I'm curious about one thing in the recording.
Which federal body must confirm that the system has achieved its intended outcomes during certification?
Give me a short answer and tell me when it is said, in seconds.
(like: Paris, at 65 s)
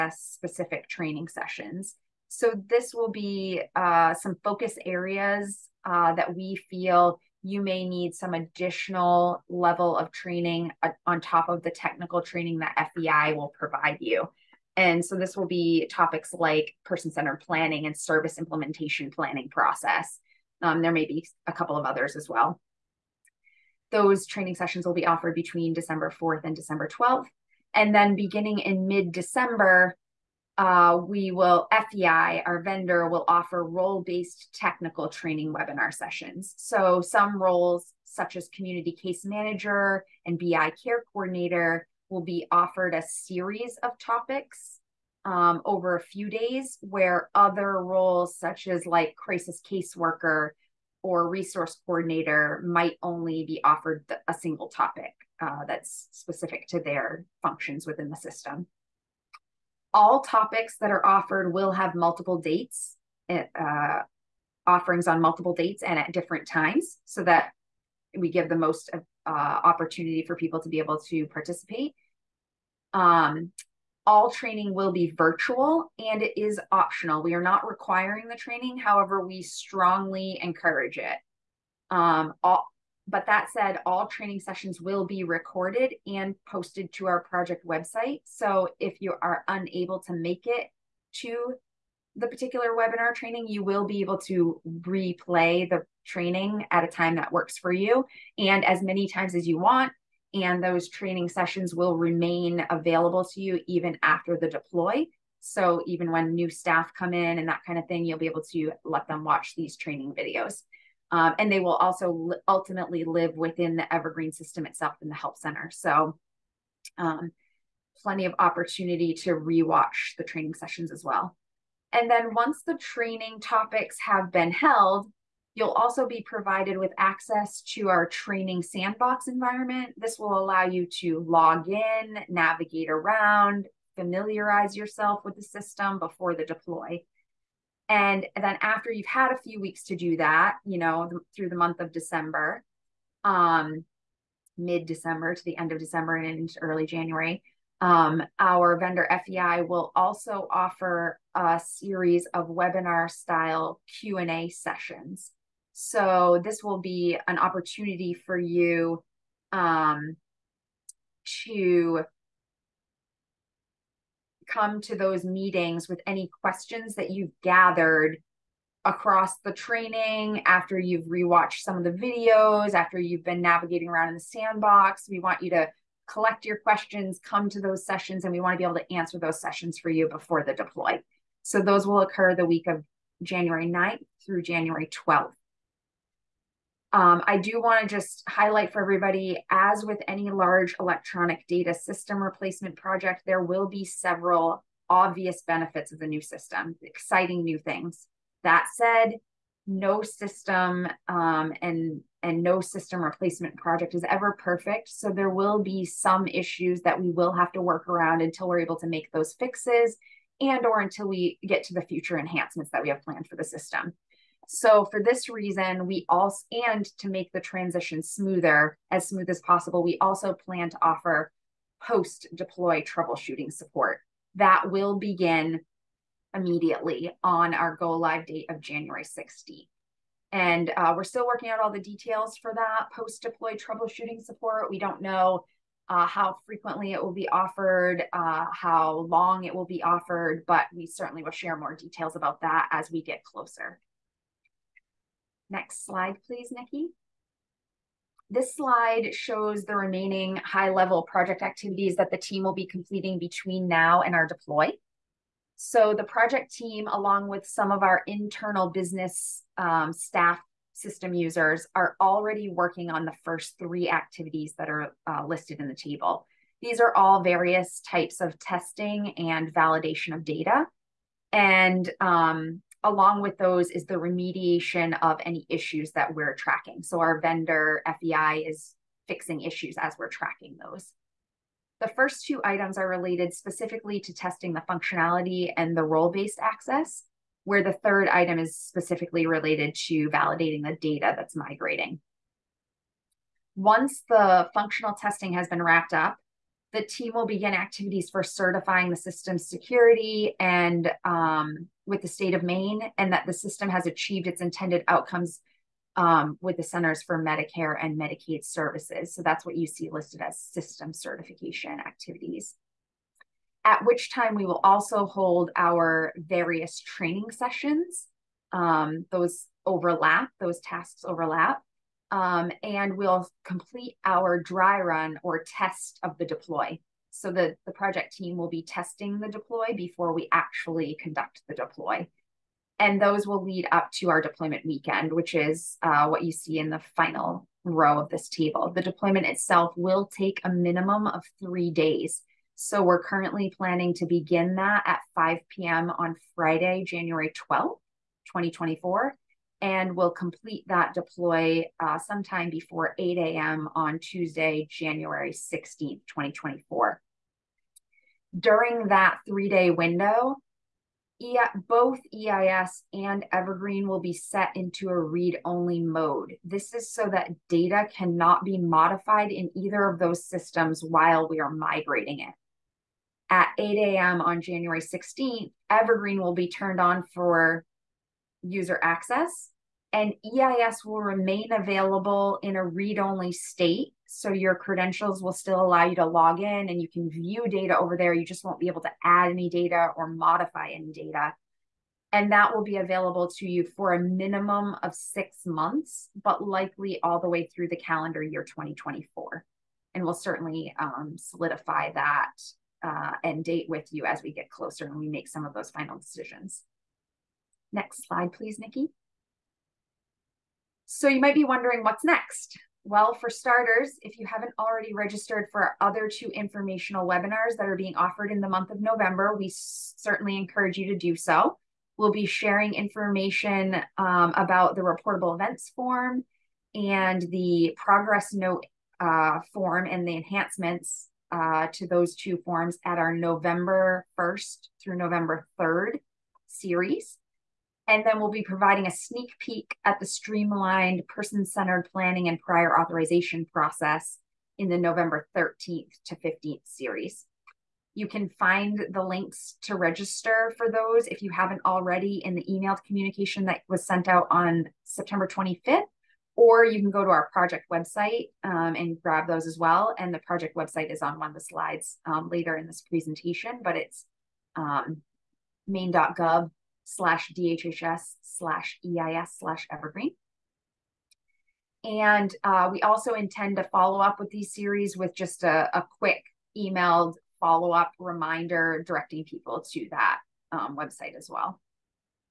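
Centers for Medicare and Medicaid Services, at 306 s.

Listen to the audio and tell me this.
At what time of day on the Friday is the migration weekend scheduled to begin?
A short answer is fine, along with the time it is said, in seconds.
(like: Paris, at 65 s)
5 p.m., at 345 s.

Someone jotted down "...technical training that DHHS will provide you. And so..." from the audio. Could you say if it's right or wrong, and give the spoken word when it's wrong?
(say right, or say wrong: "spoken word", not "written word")
wrong: "FEI", not "DHHS".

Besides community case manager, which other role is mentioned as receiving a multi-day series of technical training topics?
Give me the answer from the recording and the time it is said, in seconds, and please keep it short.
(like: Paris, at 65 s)
BI care coordinator, at 40 s.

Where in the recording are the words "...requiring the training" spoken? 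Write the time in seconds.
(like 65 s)
77 s.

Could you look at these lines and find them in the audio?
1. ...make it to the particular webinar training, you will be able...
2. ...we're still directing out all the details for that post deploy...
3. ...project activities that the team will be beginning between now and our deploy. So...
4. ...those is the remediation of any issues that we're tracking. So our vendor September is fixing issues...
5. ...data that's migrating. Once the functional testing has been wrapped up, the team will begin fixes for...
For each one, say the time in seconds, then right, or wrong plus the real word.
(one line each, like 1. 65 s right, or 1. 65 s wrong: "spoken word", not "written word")
1. 90 s right
2. 230 s wrong: "working", not "directing"
3. 251 s wrong: "completing", not "beginning"
4. 273 s wrong: "FEI", not "September"
5. 290 s wrong: "activities", not "fixes".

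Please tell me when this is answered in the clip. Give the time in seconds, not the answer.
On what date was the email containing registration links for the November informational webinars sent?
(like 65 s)
454 s.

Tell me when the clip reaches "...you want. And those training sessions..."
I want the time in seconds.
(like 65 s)
99 s.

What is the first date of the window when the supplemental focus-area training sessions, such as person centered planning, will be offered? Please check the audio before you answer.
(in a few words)
December 4th.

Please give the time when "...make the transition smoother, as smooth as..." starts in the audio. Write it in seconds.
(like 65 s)
217 s.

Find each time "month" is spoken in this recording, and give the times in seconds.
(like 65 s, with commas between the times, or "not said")
141 s, 395 s, 418 s.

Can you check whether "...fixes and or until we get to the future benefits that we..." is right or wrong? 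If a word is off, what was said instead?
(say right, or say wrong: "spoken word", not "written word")
wrong: "enhancements", not "benefits".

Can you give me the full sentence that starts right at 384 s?
So your credentials will still allow you to log in and you can view data over there.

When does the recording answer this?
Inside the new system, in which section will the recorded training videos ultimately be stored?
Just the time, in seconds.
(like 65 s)
115 s.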